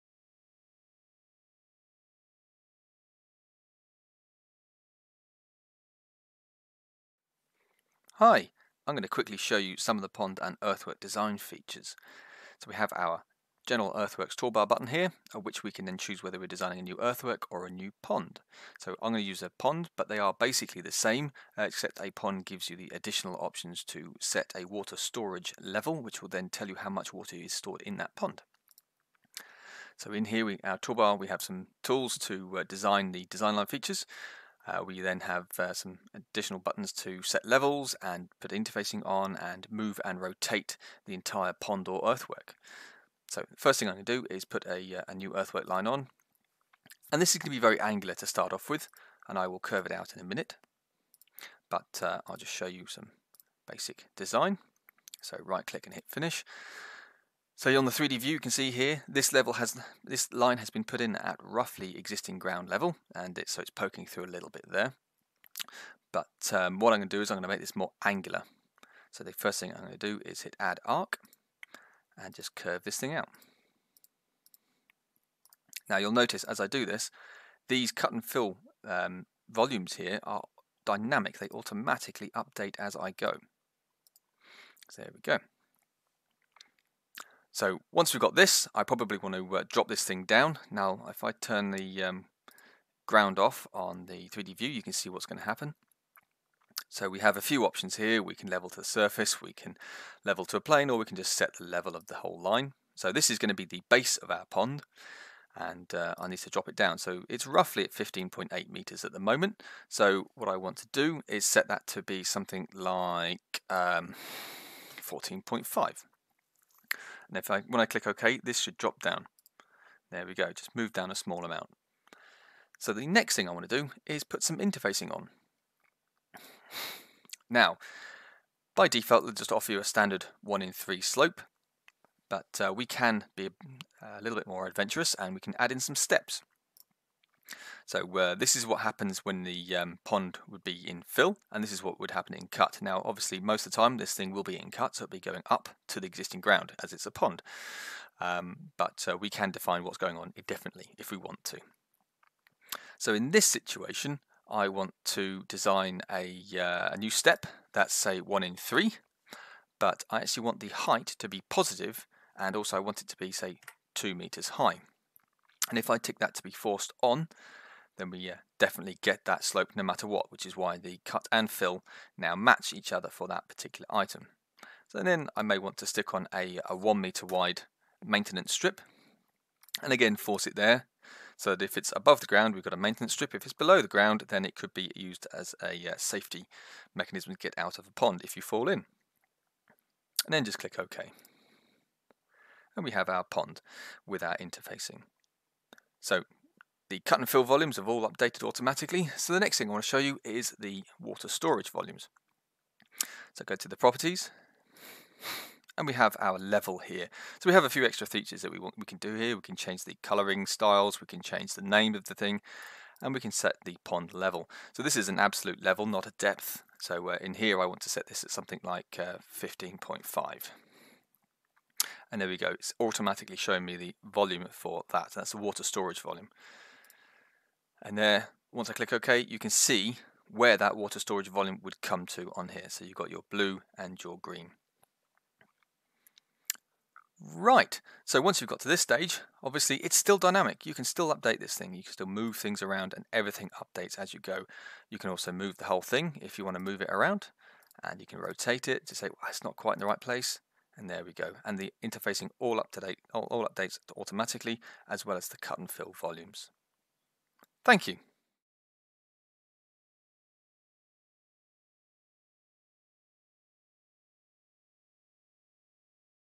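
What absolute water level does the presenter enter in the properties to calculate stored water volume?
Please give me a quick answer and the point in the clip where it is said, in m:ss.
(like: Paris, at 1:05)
15.5, at 3:38.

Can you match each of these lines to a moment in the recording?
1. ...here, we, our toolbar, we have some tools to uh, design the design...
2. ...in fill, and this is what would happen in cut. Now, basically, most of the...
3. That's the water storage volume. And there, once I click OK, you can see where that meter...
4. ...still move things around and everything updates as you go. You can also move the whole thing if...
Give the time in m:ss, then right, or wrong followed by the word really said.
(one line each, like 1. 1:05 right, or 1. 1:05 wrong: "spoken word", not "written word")
1. 0:30 right
2. 2:20 wrong: "obviously", not "basically"
3. 3:45 wrong: "water", not "meter"
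4. 4:01 right.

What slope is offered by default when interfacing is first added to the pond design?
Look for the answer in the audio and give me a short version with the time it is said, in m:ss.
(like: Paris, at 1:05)
1 in 3, at 2:10.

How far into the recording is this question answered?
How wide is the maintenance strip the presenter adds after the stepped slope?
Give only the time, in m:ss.
2:56.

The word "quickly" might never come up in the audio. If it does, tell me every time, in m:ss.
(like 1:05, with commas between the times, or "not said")
0:09.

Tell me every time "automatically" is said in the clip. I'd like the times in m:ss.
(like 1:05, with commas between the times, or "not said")
1:21, 3:18, 3:42, 4:13.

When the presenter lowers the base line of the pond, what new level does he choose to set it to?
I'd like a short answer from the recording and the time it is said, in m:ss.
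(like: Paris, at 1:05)
14.5 meters, at 1:55.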